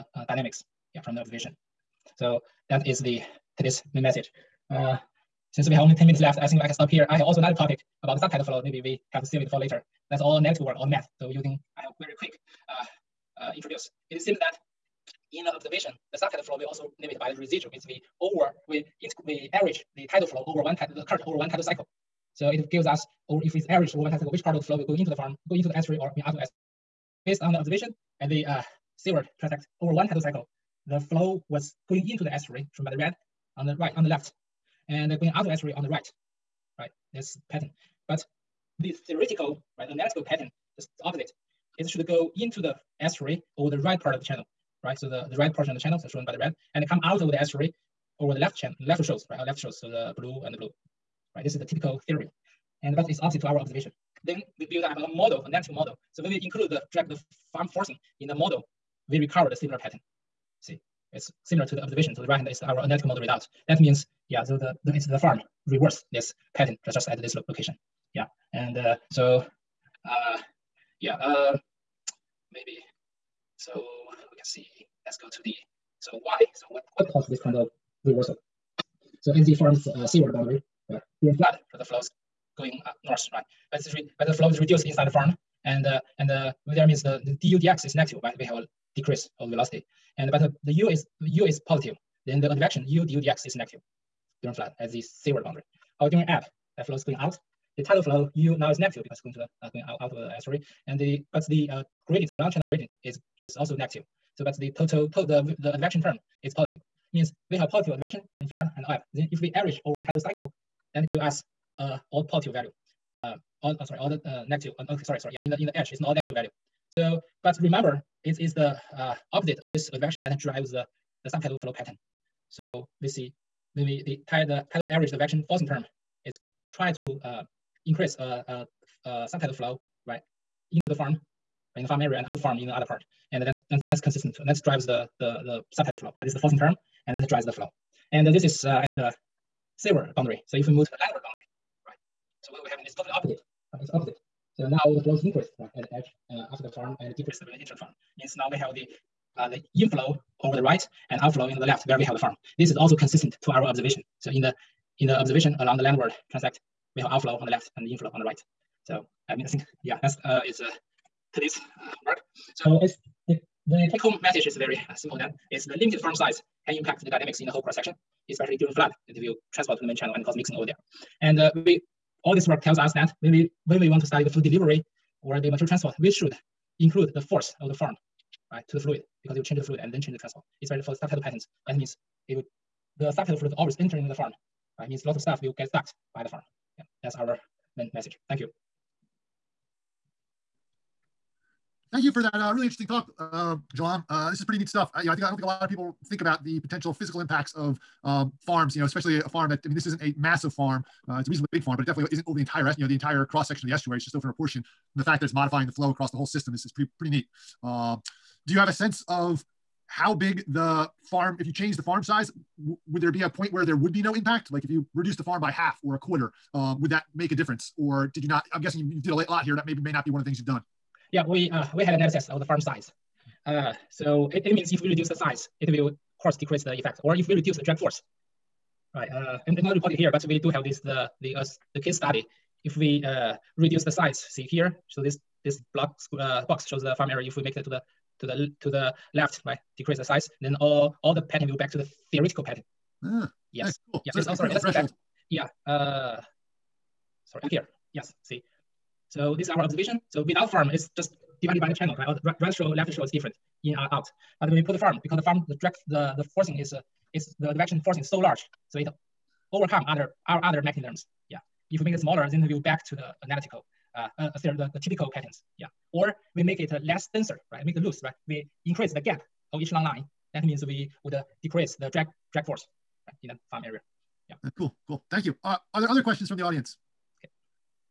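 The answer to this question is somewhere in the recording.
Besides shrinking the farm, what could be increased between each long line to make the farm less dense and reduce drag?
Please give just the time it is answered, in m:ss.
4:28.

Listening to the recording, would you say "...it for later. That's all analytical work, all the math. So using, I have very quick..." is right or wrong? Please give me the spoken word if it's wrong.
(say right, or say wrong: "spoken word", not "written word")
right.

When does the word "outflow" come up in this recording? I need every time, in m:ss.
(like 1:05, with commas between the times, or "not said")
2:31, 2:37.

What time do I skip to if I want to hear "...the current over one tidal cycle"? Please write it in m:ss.
0:20.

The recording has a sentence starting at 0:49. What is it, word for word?
Or uh, left shows, so the blue and the blue, right?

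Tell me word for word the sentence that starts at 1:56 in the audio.
So, but remember, it is the uh, opposite of this advection that drives the the subtidal flow pattern.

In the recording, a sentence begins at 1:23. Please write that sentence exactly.
As, but the flow is reduced inside the farm, and uh, and uh, there means the, the du dx is negative, right?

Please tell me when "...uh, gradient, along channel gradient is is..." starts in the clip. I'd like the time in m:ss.
1:41.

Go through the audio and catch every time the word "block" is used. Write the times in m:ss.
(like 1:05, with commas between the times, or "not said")
3:55.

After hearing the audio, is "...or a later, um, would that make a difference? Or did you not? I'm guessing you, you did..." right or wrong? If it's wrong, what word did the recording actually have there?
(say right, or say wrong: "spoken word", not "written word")
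wrong: "quarter", not "later".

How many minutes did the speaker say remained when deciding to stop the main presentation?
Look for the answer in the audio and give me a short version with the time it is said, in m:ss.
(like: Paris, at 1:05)
10, at 0:05.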